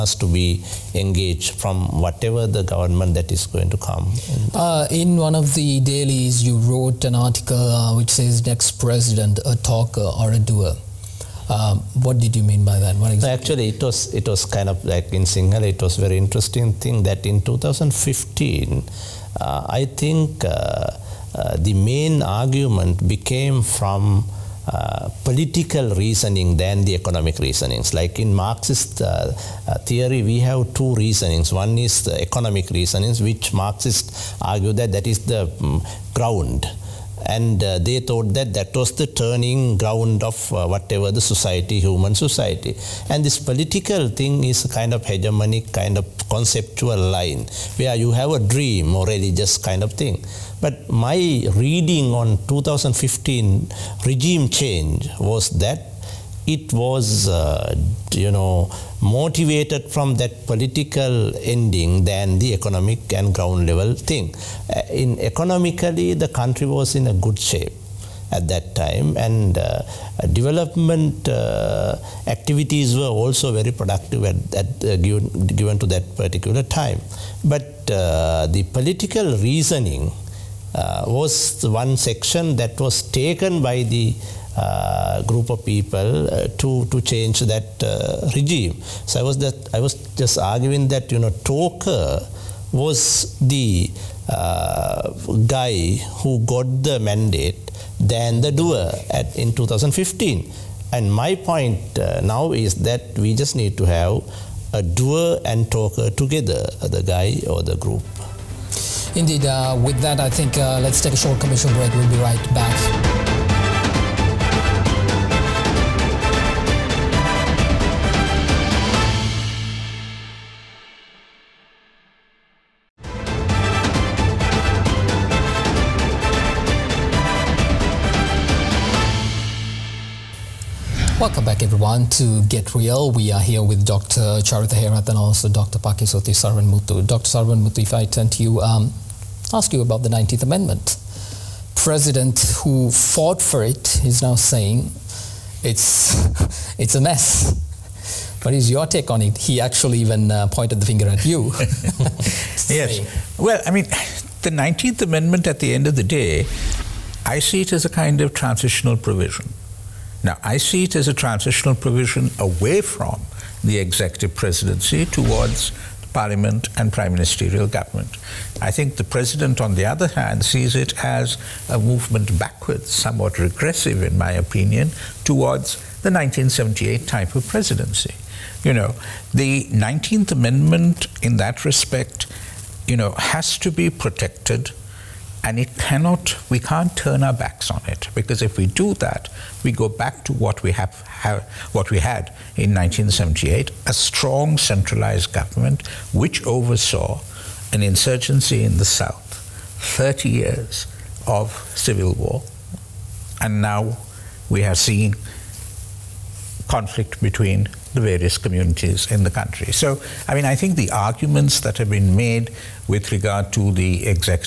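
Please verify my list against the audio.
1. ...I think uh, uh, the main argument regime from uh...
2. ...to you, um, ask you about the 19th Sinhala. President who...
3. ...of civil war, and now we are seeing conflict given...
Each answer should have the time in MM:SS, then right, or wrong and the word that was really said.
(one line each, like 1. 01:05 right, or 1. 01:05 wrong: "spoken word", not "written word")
1. 00:19 wrong: "became", not "regime"
2. 02:18 wrong: "Amendment", not "Sinhala"
3. 03:21 wrong: "between", not "given".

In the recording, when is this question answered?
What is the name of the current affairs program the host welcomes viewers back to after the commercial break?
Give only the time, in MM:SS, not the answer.
02:12.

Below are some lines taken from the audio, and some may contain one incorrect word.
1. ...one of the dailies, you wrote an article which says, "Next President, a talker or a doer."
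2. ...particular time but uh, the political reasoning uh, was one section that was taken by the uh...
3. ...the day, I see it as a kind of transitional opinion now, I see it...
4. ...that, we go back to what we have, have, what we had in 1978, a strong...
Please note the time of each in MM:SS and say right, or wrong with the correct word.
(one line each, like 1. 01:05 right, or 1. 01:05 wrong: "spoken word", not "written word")
1. 00:05 right
2. 01:16 right
3. 02:35 wrong: "provision", not "opinion"
4. 03:08 right.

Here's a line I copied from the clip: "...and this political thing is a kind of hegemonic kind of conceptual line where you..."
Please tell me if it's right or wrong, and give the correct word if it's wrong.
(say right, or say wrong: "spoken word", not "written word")
right.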